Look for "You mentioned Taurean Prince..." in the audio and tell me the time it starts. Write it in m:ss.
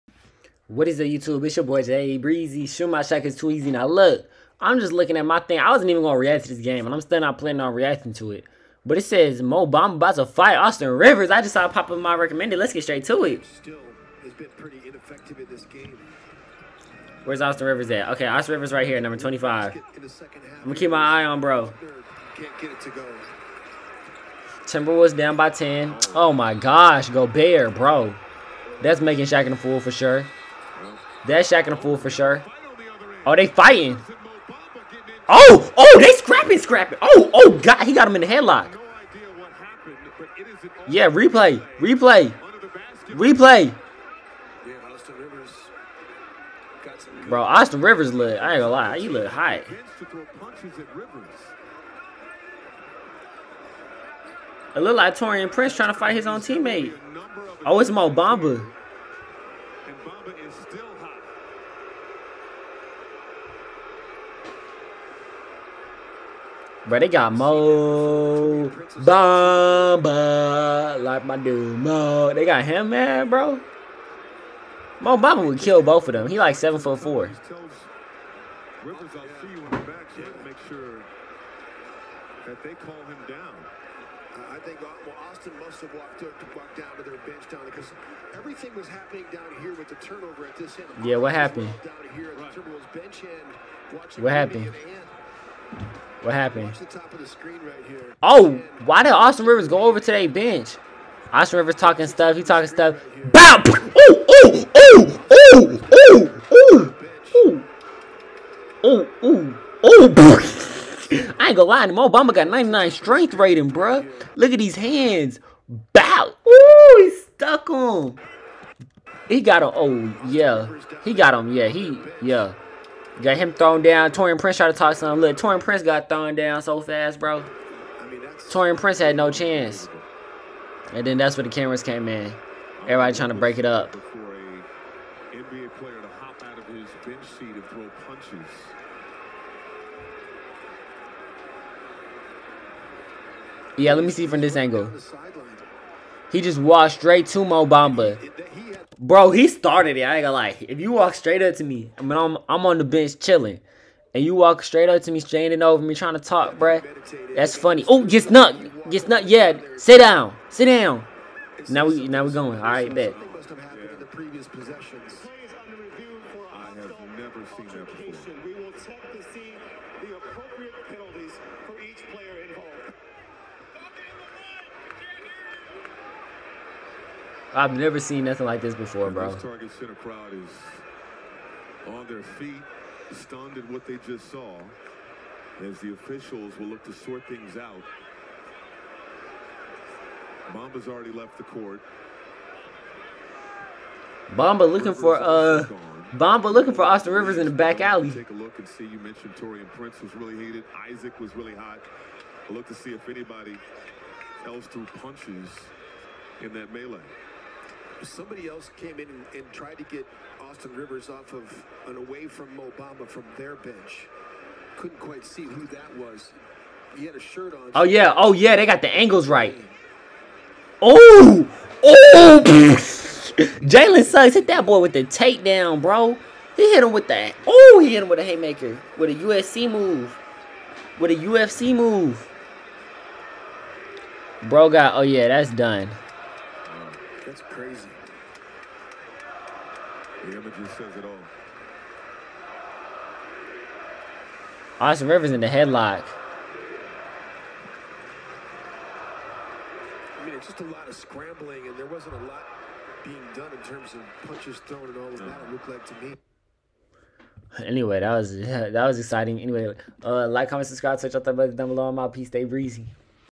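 3:18.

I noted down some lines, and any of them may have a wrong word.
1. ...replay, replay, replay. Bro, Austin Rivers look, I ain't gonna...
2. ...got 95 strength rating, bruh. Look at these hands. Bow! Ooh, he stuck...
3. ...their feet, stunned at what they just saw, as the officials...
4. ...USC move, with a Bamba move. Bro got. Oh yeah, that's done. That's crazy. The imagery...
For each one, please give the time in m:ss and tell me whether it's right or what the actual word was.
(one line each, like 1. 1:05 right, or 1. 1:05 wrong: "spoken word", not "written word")
1. 0:41 right
2. 1:52 wrong: "99", not "95"
3. 3:02 right
4. 3:49 wrong: "UFC", not "Bamba".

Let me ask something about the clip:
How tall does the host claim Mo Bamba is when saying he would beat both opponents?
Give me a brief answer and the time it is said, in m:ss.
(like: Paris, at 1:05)
7 foot 4, at 1:16.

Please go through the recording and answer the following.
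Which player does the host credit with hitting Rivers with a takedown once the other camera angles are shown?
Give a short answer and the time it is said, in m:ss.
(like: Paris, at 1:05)
Jalen Suggs, at 3:42.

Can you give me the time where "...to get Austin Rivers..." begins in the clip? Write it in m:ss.
3:29.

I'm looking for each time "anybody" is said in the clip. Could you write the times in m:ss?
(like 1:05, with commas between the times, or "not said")
3:23.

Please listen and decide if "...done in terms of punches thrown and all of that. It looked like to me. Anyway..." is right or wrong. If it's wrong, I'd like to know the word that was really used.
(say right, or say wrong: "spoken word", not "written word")
right.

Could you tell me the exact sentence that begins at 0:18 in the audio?
Okay, Austin Rivers right here, number 25.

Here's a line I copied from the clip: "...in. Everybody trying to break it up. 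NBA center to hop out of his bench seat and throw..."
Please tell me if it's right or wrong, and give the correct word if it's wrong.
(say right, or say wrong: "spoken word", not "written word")
wrong: "player", not "center".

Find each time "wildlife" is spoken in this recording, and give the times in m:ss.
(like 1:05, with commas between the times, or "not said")
not said.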